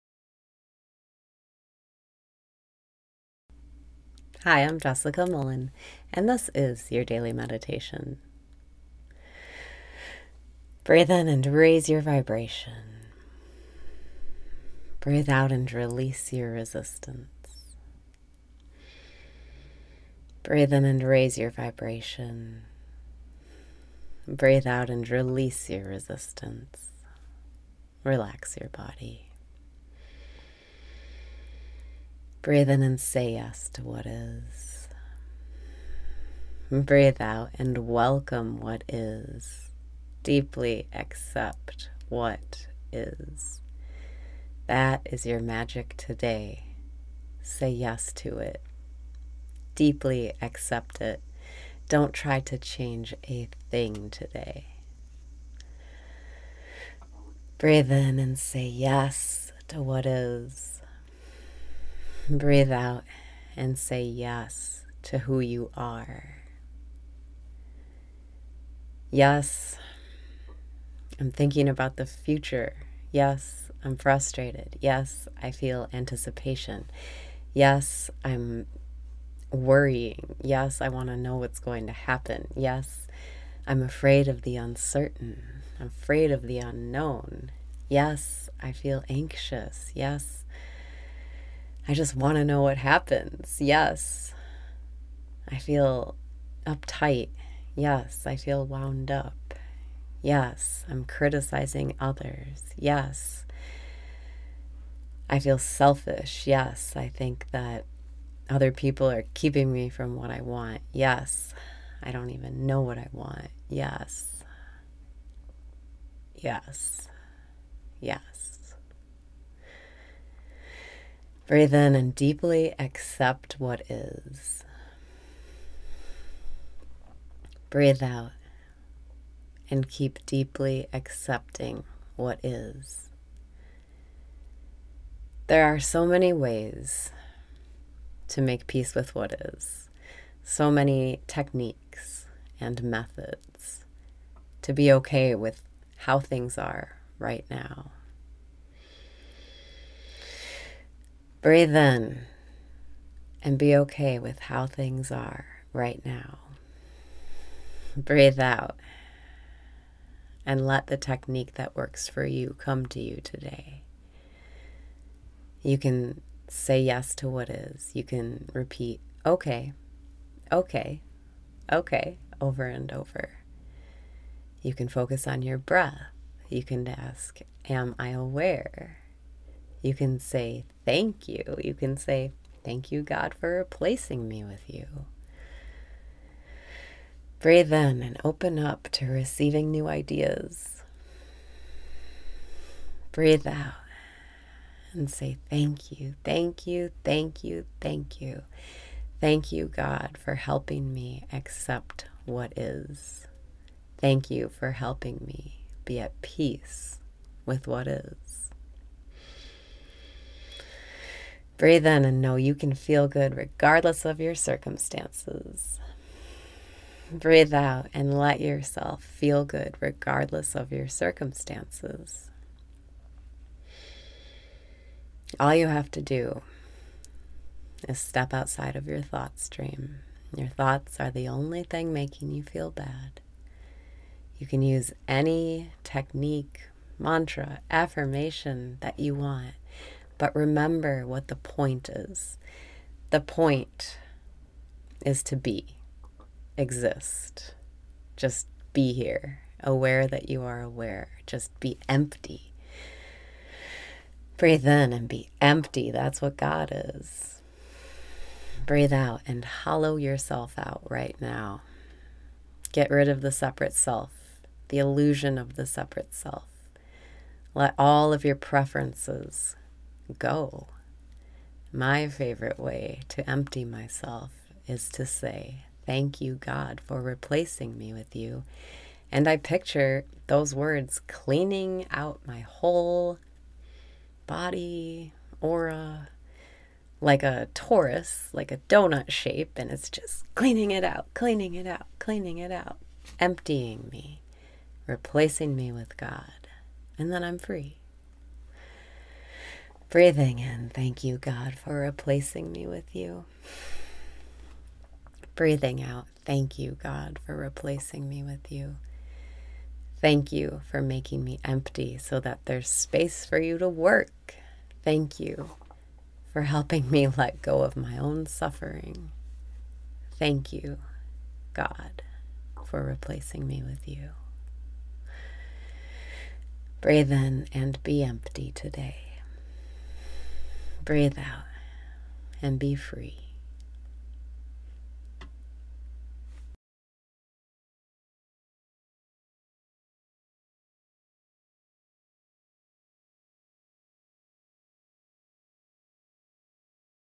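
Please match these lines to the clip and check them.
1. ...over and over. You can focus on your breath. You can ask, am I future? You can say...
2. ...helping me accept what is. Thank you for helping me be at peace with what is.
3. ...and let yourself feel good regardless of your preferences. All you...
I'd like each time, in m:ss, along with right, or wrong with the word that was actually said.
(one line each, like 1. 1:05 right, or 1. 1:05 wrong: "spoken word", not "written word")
1. 2:52 wrong: "aware", not "future"
2. 3:20 right
3. 3:37 wrong: "circumstances", not "preferences".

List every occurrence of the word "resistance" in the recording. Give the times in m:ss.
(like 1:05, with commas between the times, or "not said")
0:16, 0:25.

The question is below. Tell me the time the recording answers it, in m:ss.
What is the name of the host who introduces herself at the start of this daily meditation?
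0:04.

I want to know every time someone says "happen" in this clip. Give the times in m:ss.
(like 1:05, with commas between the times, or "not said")
1:21, 1:32.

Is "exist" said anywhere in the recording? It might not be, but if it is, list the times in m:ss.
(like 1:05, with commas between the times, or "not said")
4:06.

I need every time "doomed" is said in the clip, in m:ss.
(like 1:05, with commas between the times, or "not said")
not said.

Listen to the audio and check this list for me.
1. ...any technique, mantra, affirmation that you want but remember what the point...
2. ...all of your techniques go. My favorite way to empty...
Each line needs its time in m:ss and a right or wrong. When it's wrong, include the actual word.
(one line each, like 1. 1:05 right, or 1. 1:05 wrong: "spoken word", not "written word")
1. 3:55 right
2. 4:27 wrong: "preferences", not "techniques".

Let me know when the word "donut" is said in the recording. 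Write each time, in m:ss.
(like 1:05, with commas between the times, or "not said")
4:48.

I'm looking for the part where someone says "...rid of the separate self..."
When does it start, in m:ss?
4:22.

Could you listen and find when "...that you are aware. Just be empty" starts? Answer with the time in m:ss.
4:10.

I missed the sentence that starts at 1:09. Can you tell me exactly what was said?
Yes, I'm thinking about the future.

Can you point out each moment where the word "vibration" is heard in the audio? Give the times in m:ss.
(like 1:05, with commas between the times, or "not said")
0:12, 0:21.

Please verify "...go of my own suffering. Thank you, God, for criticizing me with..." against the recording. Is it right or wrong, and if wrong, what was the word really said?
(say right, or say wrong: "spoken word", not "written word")
wrong: "replacing", not "criticizing".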